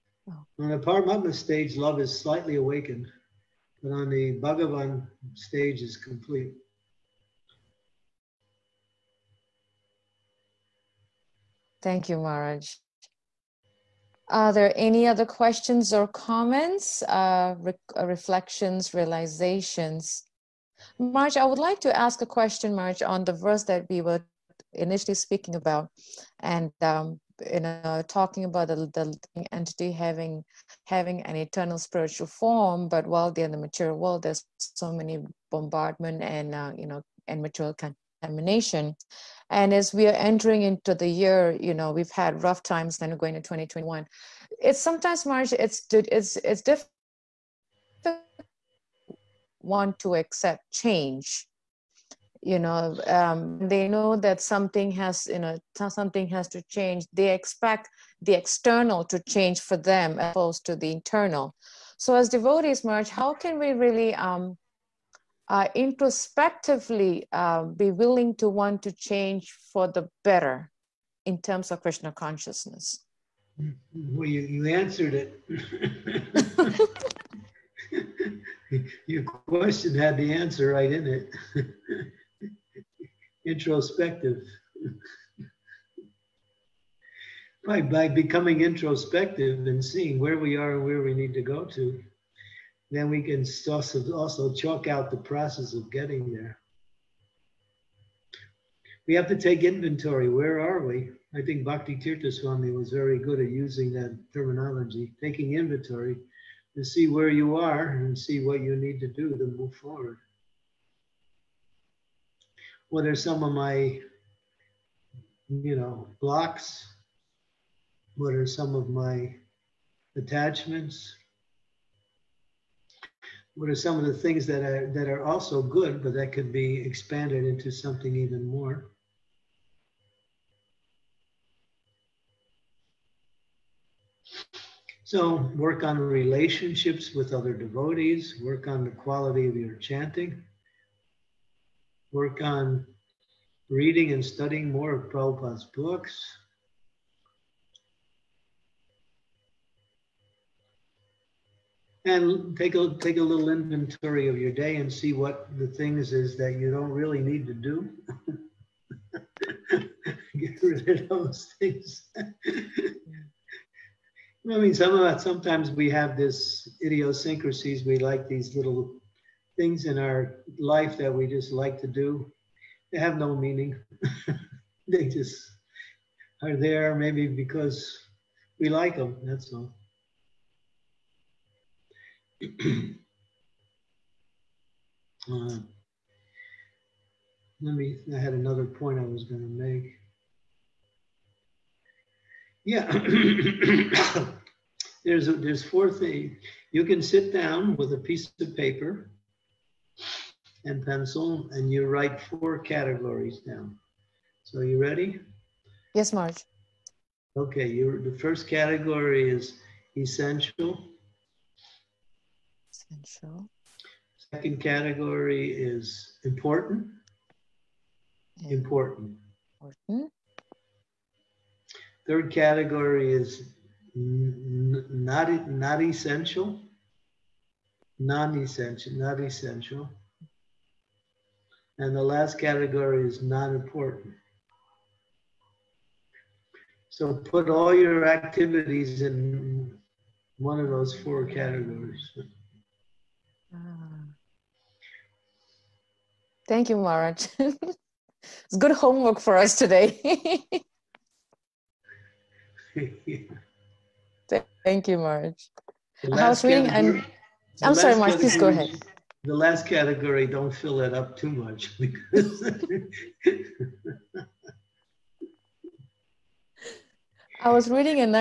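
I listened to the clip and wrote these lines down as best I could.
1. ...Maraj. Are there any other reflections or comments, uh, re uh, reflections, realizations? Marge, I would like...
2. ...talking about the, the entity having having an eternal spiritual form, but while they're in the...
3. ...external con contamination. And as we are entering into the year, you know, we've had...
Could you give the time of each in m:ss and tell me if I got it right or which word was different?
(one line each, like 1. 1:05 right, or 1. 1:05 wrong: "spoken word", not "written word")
1. 0:12 wrong: "questions", not "reflections"
2. 0:28 right
3. 0:37 wrong: "material", not "external".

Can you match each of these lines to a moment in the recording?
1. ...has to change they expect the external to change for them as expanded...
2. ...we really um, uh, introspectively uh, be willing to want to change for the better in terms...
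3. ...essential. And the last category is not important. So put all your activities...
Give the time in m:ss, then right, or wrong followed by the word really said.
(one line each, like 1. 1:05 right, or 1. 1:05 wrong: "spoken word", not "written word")
1. 0:56 wrong: "opposed", not "expanded"
2. 1:03 right
3. 3:49 right.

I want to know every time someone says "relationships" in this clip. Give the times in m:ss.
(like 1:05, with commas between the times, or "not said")
2:15.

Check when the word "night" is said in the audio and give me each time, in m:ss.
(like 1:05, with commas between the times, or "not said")
not said.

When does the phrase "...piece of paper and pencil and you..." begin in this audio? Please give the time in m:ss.
3:17.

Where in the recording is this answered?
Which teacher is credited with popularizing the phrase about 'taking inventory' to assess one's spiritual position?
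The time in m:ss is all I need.
1:41.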